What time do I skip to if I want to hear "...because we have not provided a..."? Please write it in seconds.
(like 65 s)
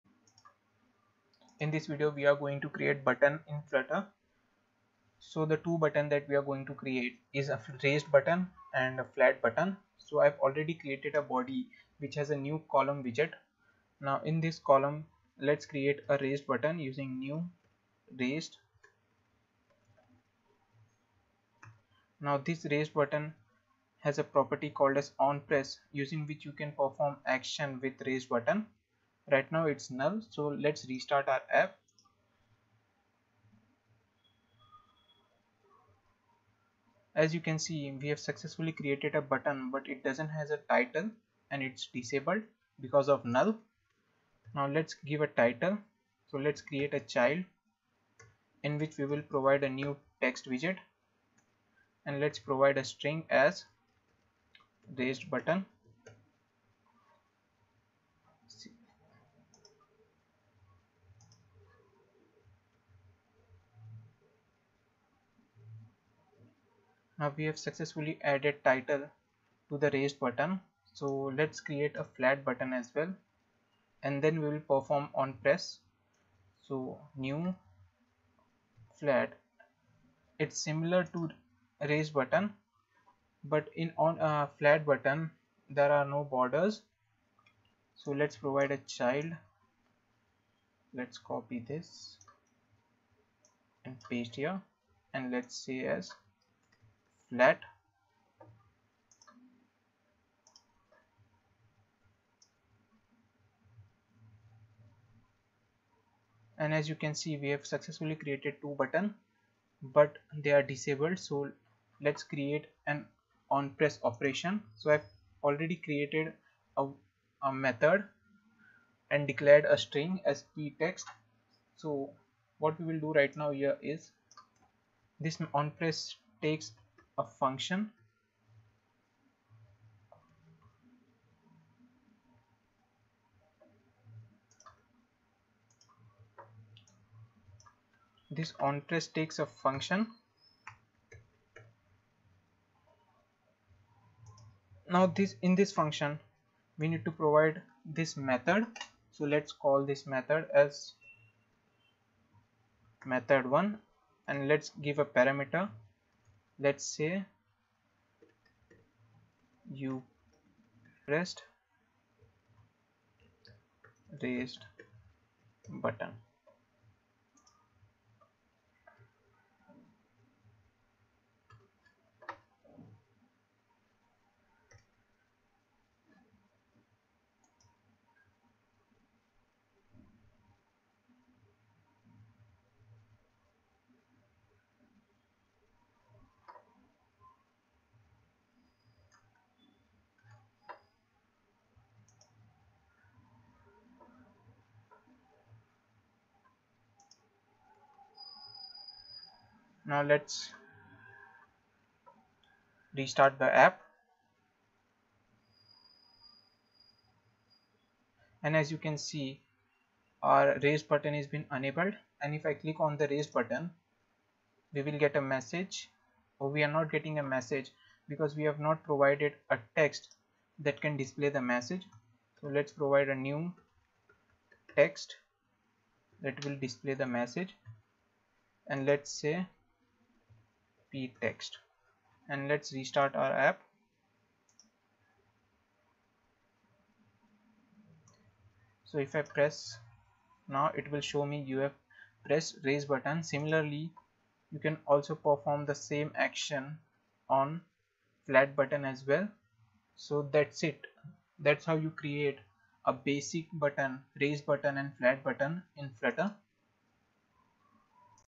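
218 s.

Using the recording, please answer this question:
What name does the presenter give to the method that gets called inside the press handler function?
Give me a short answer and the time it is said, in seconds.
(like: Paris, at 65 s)
method1, at 153 s.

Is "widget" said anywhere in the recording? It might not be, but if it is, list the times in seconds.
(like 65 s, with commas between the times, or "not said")
13 s, 50 s.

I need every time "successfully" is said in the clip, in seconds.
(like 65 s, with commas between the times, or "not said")
38 s, 67 s, 107 s.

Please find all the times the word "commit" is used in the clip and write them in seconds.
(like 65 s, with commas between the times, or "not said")
not said.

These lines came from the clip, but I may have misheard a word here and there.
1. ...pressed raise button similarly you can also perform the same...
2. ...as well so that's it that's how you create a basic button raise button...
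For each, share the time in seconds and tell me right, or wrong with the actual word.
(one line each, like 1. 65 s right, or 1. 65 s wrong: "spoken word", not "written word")
1. 242 s right
2. 248 s right.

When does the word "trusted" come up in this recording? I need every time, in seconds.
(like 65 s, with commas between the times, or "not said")
not said.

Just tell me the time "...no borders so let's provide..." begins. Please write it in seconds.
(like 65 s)
86 s.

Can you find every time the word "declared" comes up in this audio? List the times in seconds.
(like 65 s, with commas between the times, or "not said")
119 s.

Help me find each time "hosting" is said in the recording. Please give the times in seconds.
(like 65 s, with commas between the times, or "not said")
not said.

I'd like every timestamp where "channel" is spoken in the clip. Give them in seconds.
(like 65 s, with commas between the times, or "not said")
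not said.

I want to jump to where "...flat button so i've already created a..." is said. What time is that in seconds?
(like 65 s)
9 s.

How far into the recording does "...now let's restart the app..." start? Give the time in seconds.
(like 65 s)
199 s.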